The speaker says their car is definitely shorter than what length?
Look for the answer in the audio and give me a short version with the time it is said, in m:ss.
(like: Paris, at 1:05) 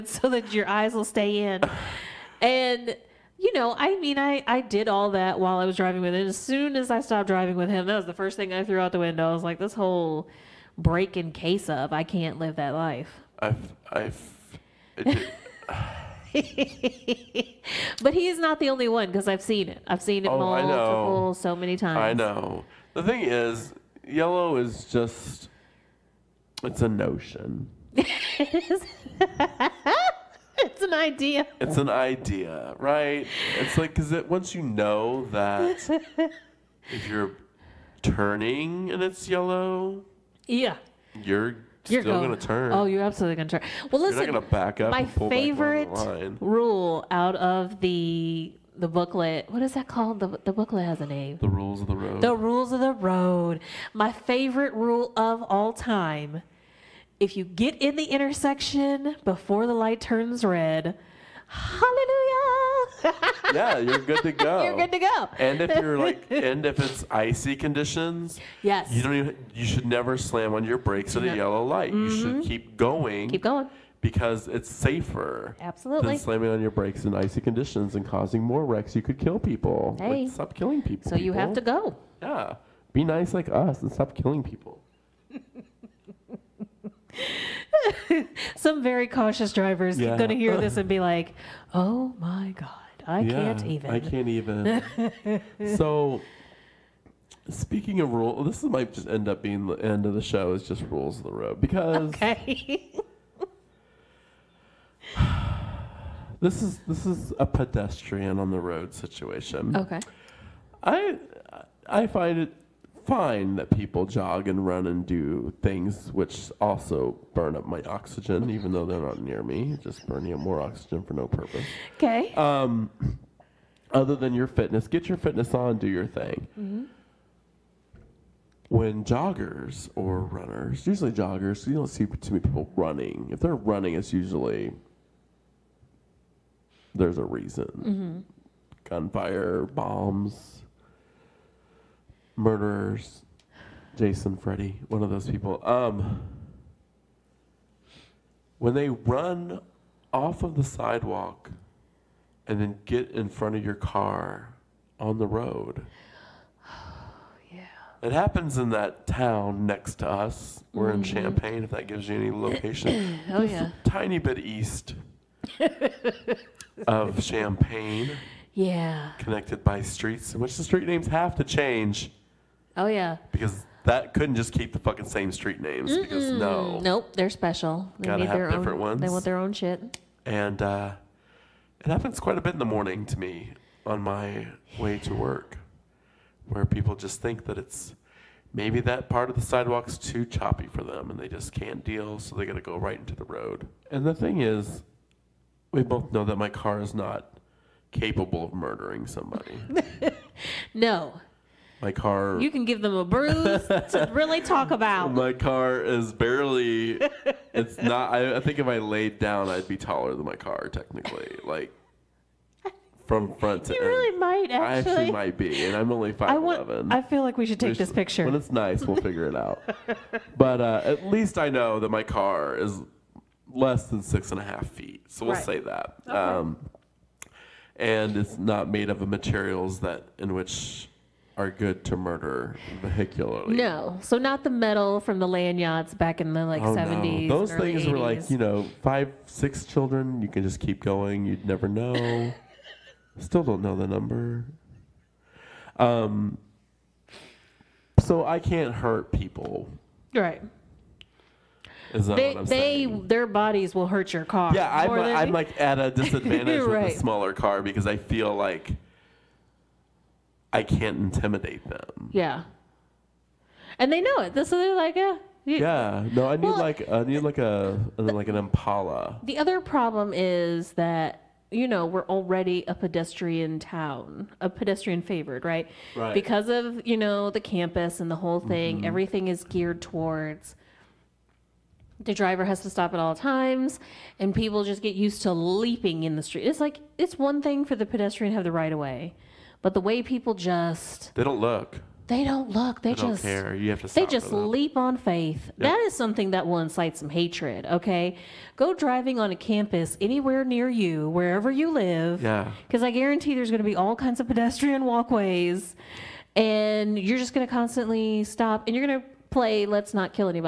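6.5 feet, at 3:44.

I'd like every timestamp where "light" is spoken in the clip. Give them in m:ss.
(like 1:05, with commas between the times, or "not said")
0:59, 1:11.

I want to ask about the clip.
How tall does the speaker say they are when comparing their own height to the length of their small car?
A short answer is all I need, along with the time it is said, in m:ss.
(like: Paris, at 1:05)
5'11", at 3:36.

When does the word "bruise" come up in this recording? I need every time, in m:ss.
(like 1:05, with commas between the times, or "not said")
3:23.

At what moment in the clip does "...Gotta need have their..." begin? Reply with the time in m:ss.
2:58.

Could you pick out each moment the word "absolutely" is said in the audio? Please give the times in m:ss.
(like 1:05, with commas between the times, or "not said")
0:43, 1:15.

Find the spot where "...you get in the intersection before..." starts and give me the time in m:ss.
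0:57.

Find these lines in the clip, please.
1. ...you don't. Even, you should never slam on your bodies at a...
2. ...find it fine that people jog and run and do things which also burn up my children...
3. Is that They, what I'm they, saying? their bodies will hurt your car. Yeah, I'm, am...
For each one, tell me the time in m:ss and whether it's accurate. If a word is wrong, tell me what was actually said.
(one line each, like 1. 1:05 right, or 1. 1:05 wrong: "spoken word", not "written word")
1. 1:08 wrong: "brakes", not "bodies"
2. 1:52 wrong: "oxygen", not "children"
3. 4:11 right.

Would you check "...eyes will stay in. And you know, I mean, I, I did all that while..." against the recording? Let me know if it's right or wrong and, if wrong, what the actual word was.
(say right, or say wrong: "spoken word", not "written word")
right.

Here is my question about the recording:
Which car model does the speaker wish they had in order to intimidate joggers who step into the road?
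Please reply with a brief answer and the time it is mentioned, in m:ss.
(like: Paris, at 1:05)
Impala, at 4:28.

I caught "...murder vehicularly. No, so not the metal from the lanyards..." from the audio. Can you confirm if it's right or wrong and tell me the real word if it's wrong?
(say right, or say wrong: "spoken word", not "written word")
right.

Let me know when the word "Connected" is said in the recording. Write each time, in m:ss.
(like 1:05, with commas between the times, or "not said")
2:49.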